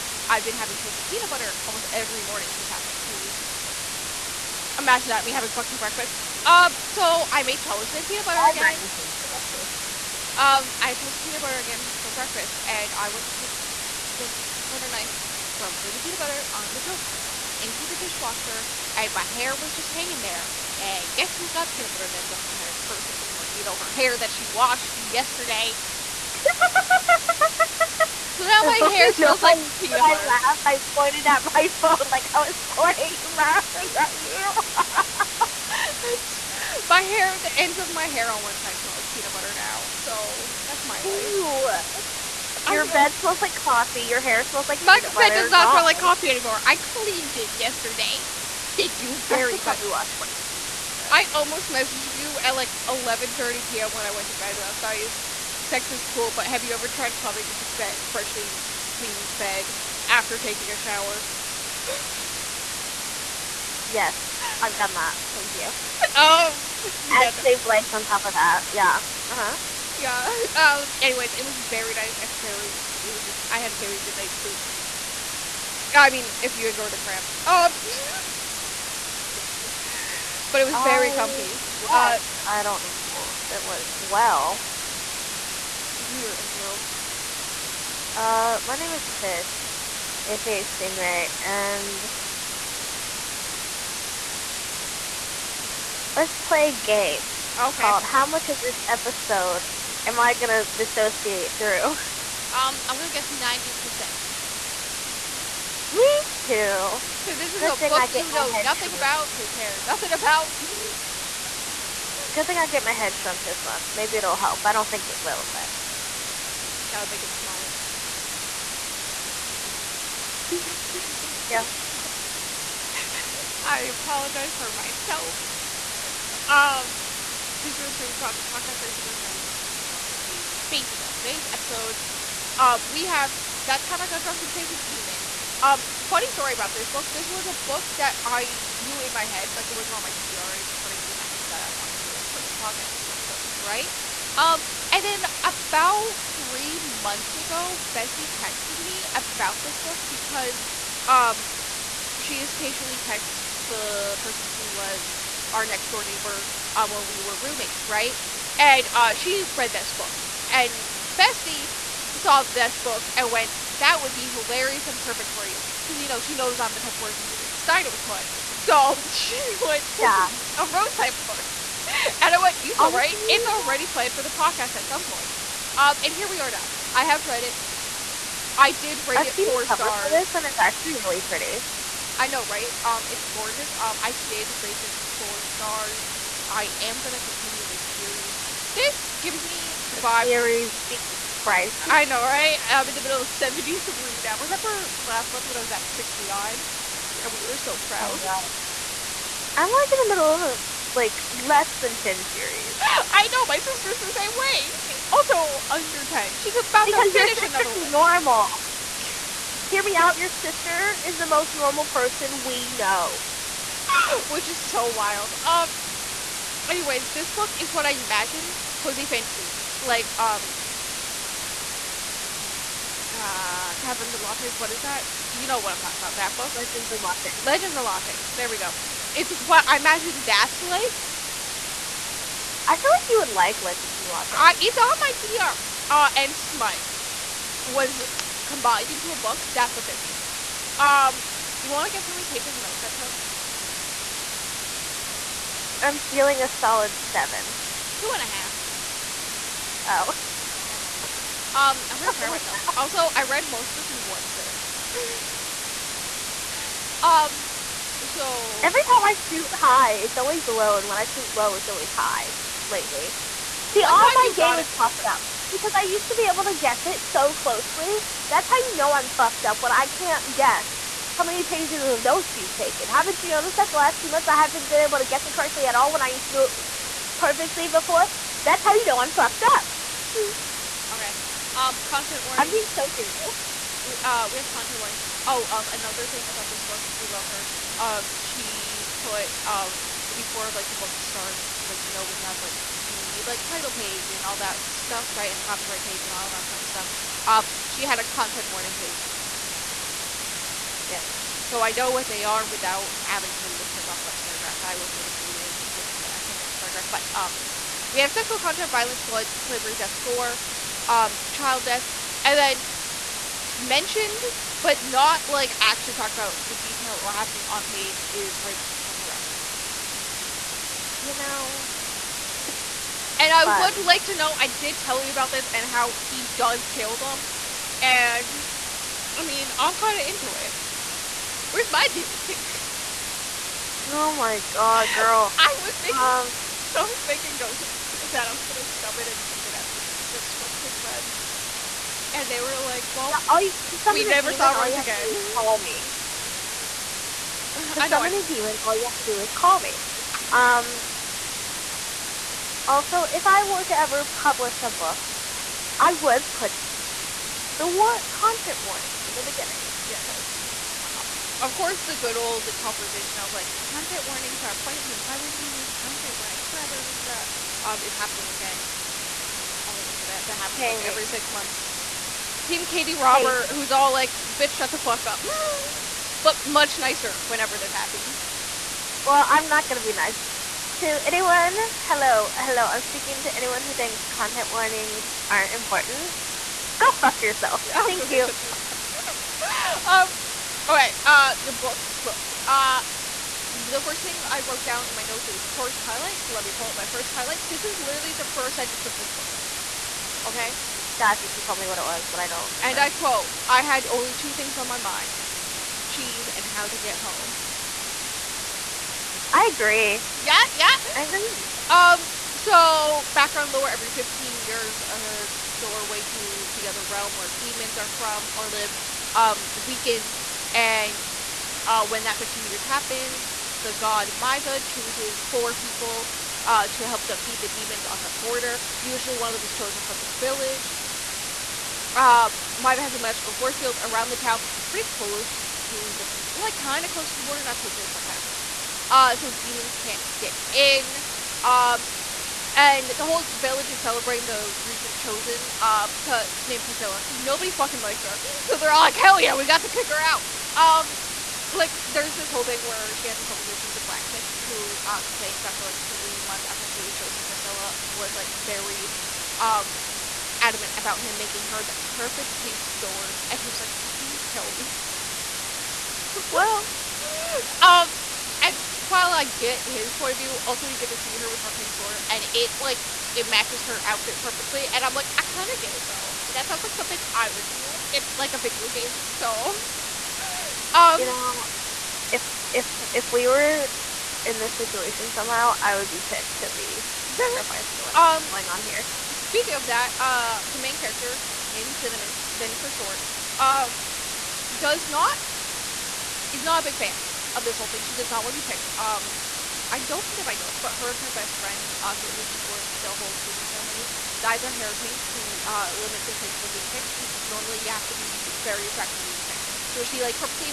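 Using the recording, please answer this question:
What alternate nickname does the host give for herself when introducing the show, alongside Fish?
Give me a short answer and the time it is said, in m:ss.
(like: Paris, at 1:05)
Stingray, at 1:30.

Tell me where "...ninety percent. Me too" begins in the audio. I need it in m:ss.
1:43.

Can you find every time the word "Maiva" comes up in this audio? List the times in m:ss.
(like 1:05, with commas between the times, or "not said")
7:04, 7:12.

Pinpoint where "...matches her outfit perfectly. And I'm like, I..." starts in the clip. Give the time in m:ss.
7:53.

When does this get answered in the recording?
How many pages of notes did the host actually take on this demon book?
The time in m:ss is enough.
4:07.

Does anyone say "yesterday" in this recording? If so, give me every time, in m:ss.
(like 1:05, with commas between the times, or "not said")
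0:24, 0:47.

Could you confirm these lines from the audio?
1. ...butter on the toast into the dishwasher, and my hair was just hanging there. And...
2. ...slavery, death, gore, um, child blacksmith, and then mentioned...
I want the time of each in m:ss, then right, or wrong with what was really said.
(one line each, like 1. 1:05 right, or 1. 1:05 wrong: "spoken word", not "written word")
1. 0:16 right
2. 5:09 wrong: "death", not "blacksmith".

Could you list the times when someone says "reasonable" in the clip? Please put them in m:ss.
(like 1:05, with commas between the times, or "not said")
not said.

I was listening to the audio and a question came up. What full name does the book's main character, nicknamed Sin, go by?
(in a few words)
Cinnamon.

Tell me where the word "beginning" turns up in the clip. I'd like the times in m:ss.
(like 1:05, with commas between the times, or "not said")
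5:59.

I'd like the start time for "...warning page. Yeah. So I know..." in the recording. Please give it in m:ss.
4:58.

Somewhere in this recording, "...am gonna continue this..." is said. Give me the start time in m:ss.
3:06.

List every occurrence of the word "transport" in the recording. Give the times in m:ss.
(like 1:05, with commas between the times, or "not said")
not said.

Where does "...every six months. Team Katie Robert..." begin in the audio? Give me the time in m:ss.
6:10.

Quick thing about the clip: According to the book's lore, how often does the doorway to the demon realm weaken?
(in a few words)
every 15 years.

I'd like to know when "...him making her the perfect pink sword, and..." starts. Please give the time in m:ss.
7:40.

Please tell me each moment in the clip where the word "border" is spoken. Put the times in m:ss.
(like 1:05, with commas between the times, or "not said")
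7:08, 7:17.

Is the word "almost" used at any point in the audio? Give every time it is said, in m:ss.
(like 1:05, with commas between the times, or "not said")
0:01, 0:51.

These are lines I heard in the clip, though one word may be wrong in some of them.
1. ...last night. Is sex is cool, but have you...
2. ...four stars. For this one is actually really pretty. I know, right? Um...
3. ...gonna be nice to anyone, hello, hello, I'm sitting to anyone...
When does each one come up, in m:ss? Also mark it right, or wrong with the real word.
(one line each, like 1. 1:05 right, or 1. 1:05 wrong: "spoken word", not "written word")
1. 0:54 right
2. 2:59 right
3. 6:19 wrong: "speaking", not "sitting".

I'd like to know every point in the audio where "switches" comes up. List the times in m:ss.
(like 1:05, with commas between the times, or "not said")
not said.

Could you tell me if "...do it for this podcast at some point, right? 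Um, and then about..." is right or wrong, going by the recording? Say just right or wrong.
right.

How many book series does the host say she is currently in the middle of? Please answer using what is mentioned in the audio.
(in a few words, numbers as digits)
73.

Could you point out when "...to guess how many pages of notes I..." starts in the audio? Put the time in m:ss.
4:01.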